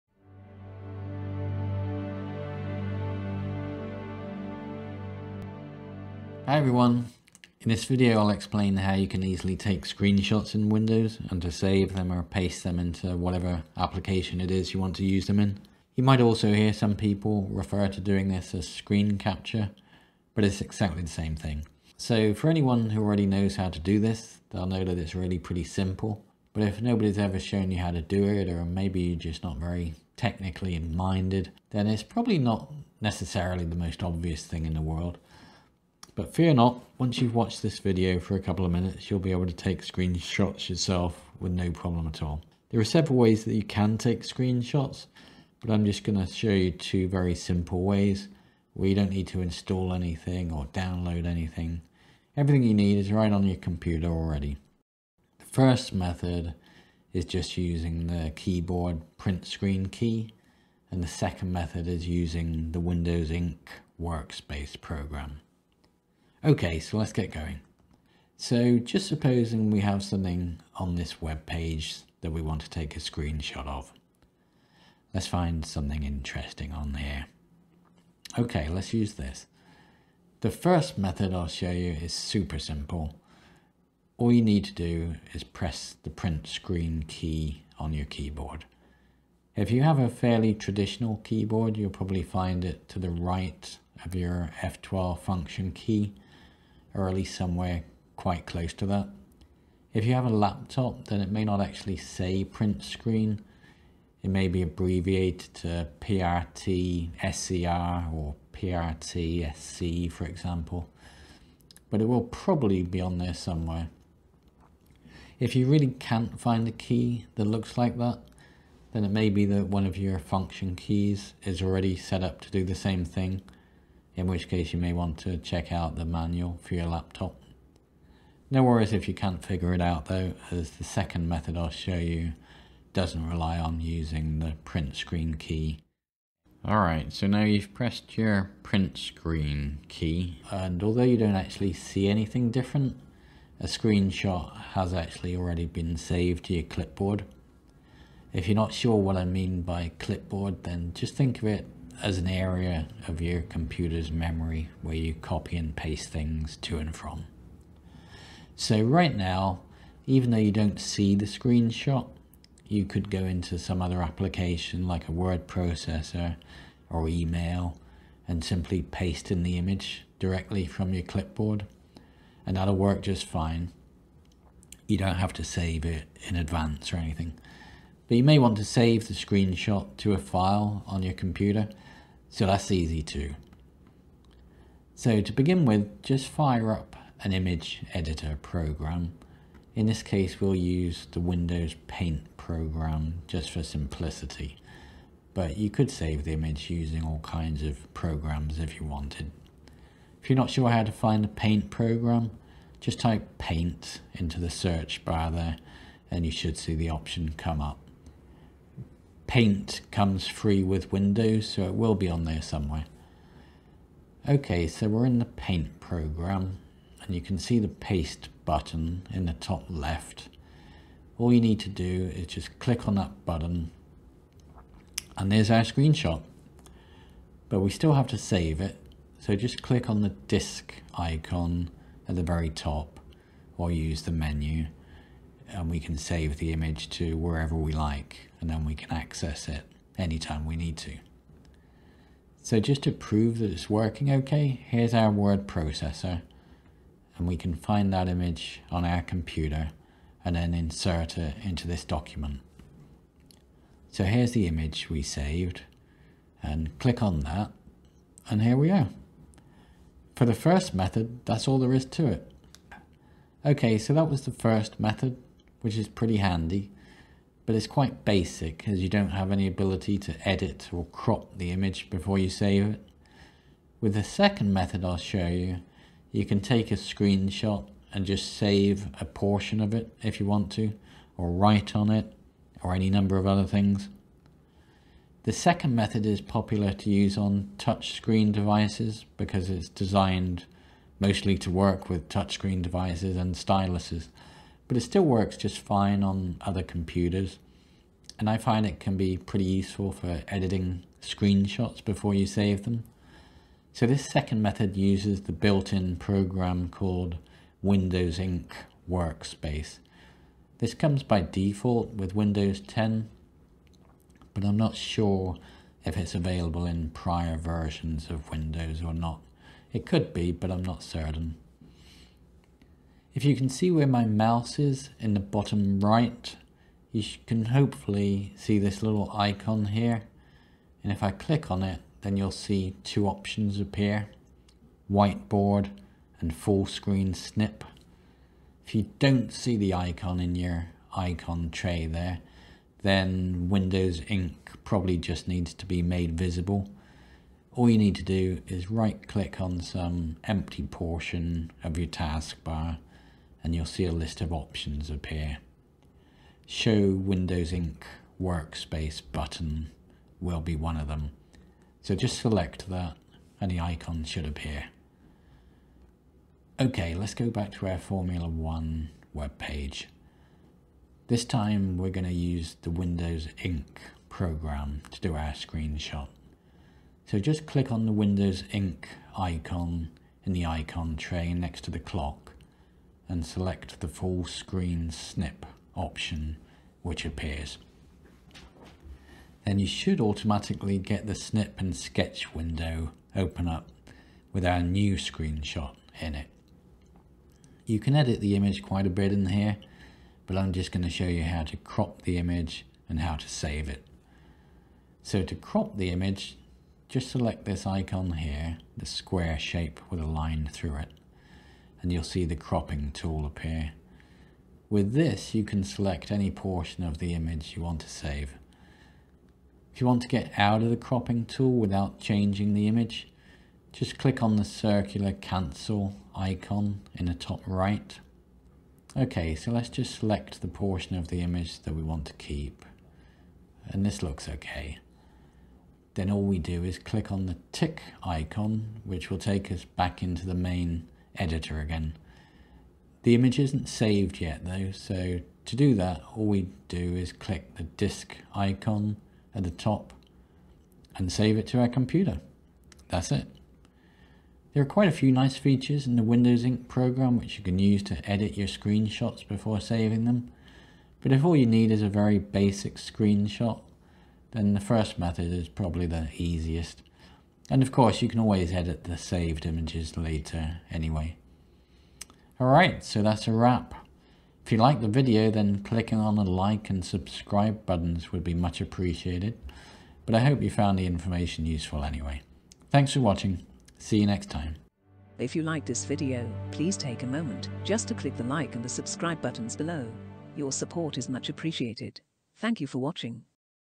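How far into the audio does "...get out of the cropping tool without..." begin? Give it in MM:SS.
07:00.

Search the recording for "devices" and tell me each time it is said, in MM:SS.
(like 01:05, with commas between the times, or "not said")
04:48, 04:52.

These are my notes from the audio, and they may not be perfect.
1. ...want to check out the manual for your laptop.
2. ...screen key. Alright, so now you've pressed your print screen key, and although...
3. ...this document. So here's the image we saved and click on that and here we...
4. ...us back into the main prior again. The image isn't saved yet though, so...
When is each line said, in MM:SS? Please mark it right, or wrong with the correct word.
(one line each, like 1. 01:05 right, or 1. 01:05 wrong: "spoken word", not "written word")
1. 02:04 right
2. 02:14 right
3. 04:11 right
4. 07:19 wrong: "editor", not "prior".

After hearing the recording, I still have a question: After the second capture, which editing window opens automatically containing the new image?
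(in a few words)
snip and sketch.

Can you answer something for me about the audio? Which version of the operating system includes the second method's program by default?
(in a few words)
Windows 10.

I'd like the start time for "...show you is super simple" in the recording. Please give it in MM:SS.
01:21.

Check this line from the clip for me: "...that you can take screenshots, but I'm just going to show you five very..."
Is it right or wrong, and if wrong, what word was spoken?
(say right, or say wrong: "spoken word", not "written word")
wrong: "two", not "five".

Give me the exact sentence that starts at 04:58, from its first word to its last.
And I find it can be pretty useful for editing screenshots before you save them.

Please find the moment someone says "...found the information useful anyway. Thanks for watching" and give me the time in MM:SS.
08:00.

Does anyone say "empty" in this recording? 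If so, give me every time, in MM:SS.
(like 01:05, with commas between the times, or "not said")
05:50.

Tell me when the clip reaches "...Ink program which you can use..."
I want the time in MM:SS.
07:36.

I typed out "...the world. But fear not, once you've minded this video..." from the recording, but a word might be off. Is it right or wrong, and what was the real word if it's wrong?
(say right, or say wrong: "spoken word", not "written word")
wrong: "watched", not "minded".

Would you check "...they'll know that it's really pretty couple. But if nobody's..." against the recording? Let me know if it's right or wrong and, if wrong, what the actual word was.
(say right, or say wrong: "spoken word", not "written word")
wrong: "simple", not "couple".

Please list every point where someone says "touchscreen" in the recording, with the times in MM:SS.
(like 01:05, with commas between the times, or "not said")
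04:47, 04:52.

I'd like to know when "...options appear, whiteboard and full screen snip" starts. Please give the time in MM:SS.
05:33.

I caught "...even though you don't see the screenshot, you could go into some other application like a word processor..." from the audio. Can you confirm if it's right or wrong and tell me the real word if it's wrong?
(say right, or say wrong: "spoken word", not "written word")
right.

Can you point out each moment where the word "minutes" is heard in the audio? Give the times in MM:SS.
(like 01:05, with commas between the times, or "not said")
00:38.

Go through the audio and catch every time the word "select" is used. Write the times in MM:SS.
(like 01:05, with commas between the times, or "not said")
06:02, 06:23, 06:47, 06:55, 07:09.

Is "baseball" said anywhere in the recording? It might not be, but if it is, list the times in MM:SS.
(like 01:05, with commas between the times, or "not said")
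not said.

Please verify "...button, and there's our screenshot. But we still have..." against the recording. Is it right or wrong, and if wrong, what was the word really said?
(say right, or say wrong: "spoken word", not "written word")
right.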